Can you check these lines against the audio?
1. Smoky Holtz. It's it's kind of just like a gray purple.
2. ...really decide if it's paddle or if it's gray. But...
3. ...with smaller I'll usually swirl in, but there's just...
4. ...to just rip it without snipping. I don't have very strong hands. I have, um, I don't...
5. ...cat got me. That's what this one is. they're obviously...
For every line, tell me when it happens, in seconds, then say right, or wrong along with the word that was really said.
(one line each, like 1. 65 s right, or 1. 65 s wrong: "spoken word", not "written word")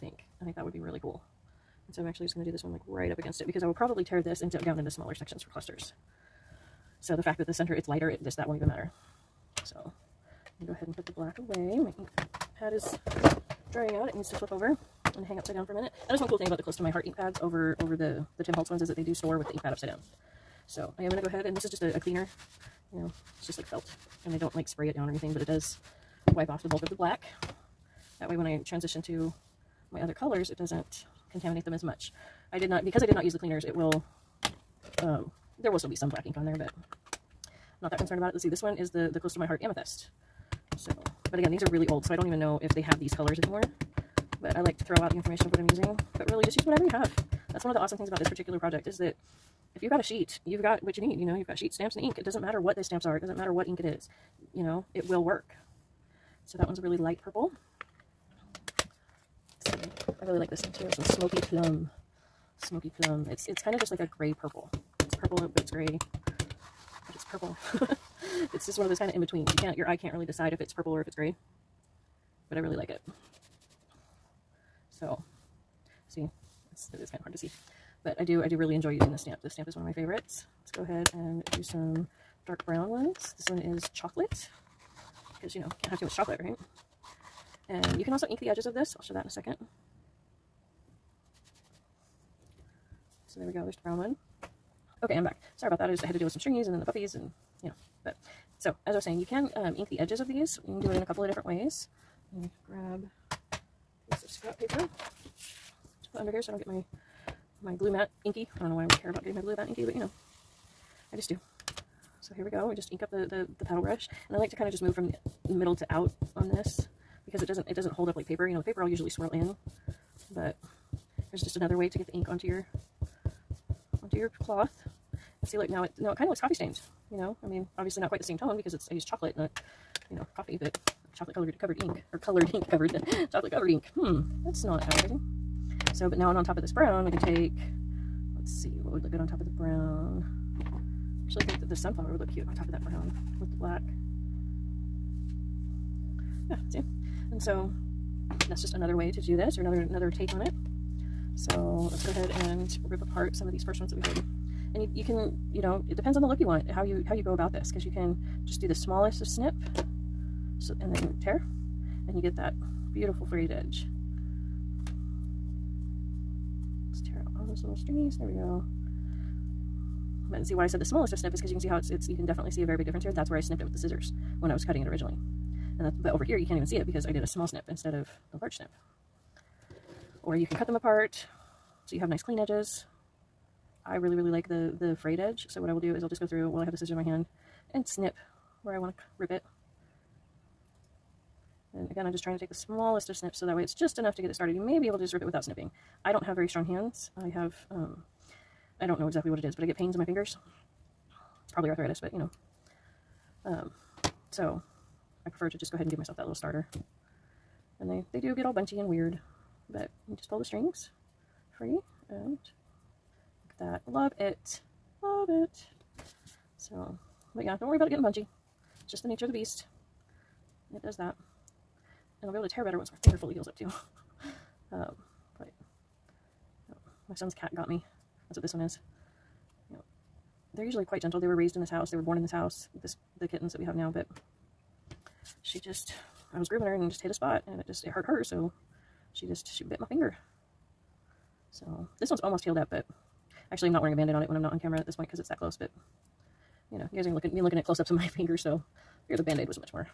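1. 62 s wrong: "Plum", not "Holtz"
2. 70 s wrong: "purple", not "paddle"
3. 118 s wrong: "paper", not "smaller"
4. 194 s right
5. 227 s wrong: "usually", not "obviously".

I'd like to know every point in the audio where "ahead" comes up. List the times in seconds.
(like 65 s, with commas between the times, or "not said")
10 s, 21 s, 80 s, 152 s, 205 s.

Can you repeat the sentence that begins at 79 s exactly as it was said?
This stamp is one of my favorites.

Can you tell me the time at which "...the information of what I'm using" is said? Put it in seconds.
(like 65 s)
45 s.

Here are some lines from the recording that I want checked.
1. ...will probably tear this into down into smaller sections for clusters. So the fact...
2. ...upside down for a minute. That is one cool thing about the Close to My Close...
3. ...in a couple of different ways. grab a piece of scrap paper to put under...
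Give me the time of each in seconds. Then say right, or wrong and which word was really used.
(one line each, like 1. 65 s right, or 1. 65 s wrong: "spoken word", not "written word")
1. 3 s right
2. 15 s wrong: "Heart", not "Close"
3. 100 s right.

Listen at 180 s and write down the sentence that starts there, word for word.
Or you can cut them apart so you have nice clean edges.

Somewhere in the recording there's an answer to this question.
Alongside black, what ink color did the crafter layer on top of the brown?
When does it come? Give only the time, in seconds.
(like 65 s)
141 s.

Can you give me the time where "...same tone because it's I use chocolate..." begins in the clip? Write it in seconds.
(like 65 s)
128 s.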